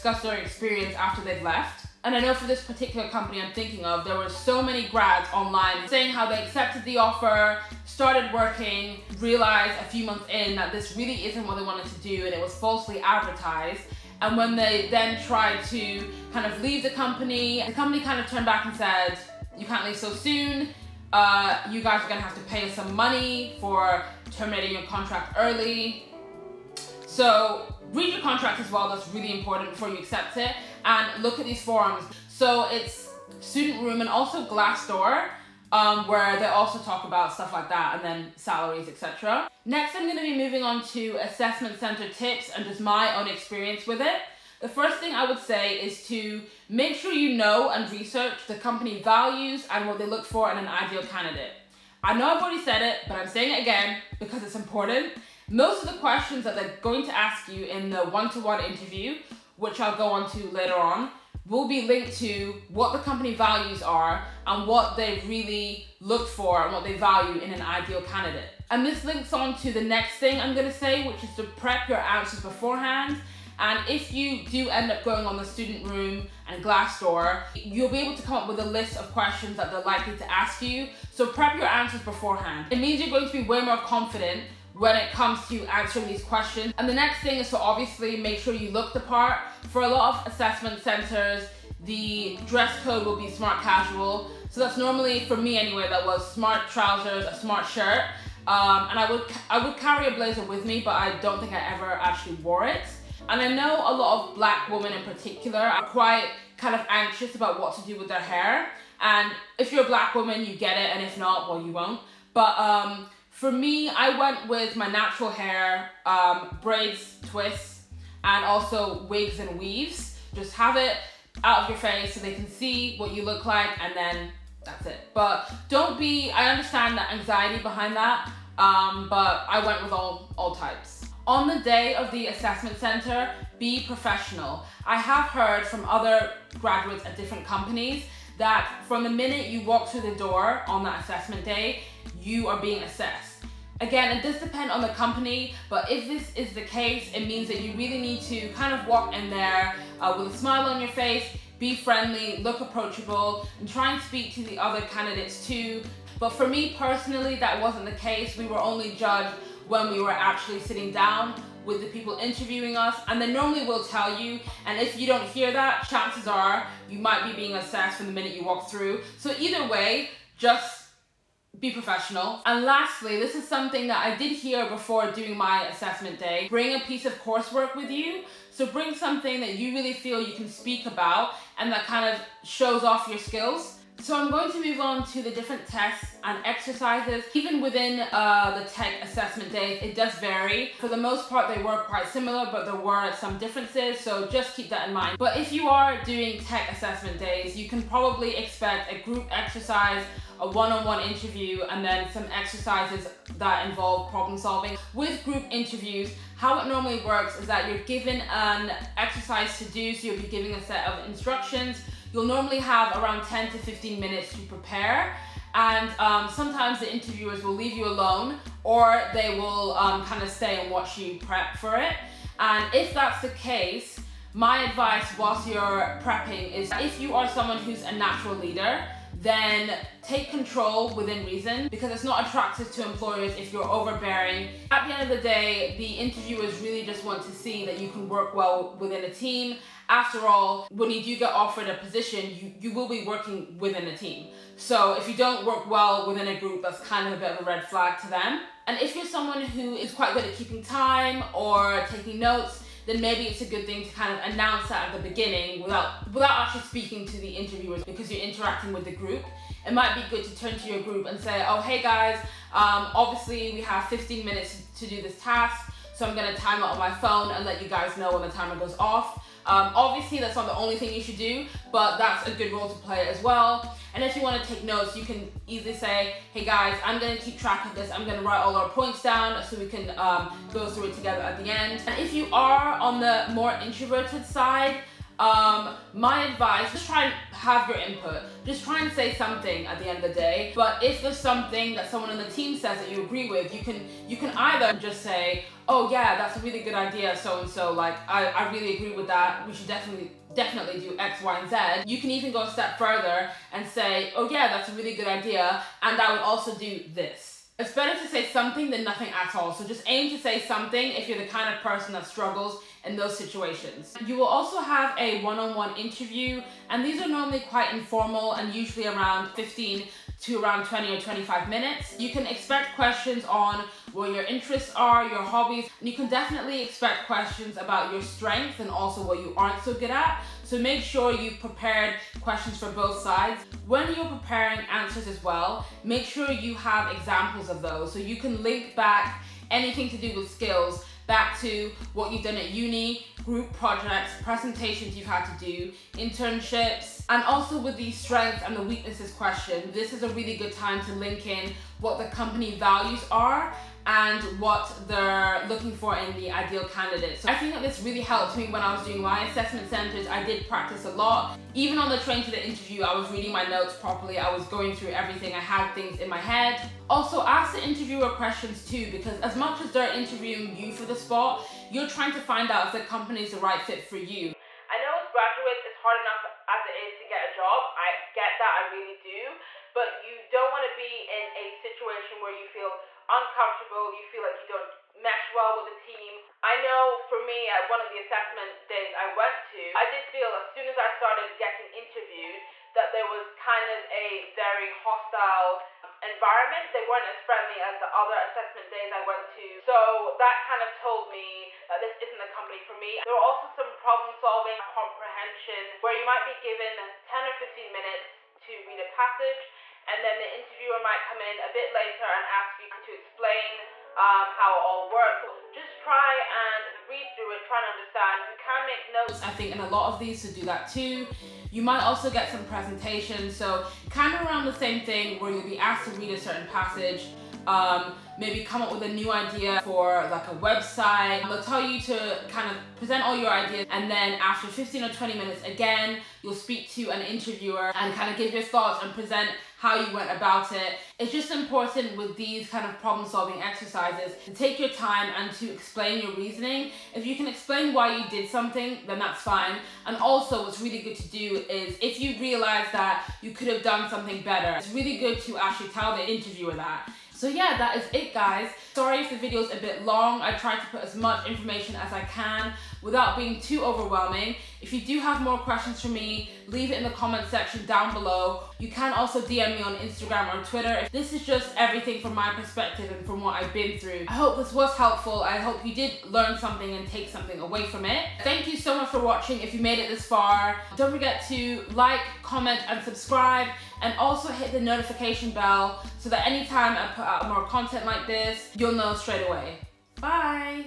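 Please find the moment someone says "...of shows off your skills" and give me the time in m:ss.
3:02.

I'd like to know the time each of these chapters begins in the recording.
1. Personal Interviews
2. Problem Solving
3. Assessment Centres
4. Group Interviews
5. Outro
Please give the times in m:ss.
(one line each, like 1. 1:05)
1. 5:13
2. 6:42
3. 0:38
4. 3:24
5. 7:37.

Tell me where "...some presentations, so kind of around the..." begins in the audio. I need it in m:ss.
7:02.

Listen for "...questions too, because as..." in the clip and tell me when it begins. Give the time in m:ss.
6:08.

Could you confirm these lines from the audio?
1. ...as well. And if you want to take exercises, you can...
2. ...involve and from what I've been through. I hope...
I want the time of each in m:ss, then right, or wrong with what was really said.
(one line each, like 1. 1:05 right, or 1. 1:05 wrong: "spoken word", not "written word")
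1. 4:33 wrong: "notes", not "exercises"
2. 7:52 wrong: "perspective", not "involve".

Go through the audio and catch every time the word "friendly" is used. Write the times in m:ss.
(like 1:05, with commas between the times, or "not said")
2:31, 6:37.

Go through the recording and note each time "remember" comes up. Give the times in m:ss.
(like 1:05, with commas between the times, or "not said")
not said.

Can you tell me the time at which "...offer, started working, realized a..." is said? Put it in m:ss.
0:06.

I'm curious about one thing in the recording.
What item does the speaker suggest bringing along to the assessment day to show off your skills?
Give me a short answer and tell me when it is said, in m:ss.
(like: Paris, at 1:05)
A piece of coursework, at 2:56.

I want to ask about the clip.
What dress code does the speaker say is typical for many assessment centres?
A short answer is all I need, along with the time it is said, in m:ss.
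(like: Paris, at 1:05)
Smart casual, at 1:33.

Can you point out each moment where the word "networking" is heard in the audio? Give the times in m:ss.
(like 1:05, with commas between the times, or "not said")
not said.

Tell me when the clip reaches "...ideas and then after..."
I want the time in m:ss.
7:13.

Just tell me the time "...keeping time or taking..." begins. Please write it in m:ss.
4:10.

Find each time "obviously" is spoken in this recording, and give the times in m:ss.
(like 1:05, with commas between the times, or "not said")
1:27, 4:22, 4:29.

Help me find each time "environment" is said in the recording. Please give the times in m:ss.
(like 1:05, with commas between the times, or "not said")
6:36.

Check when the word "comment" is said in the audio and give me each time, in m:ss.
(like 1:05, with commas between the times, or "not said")
7:46, 8:02.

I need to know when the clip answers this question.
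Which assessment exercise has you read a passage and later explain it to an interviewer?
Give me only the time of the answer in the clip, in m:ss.
6:44.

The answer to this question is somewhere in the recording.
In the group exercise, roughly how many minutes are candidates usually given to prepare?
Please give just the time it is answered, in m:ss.
3:33.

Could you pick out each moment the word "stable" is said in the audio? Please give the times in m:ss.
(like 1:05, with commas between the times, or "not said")
not said.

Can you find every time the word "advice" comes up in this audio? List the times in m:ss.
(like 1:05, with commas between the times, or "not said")
3:44, 4:46.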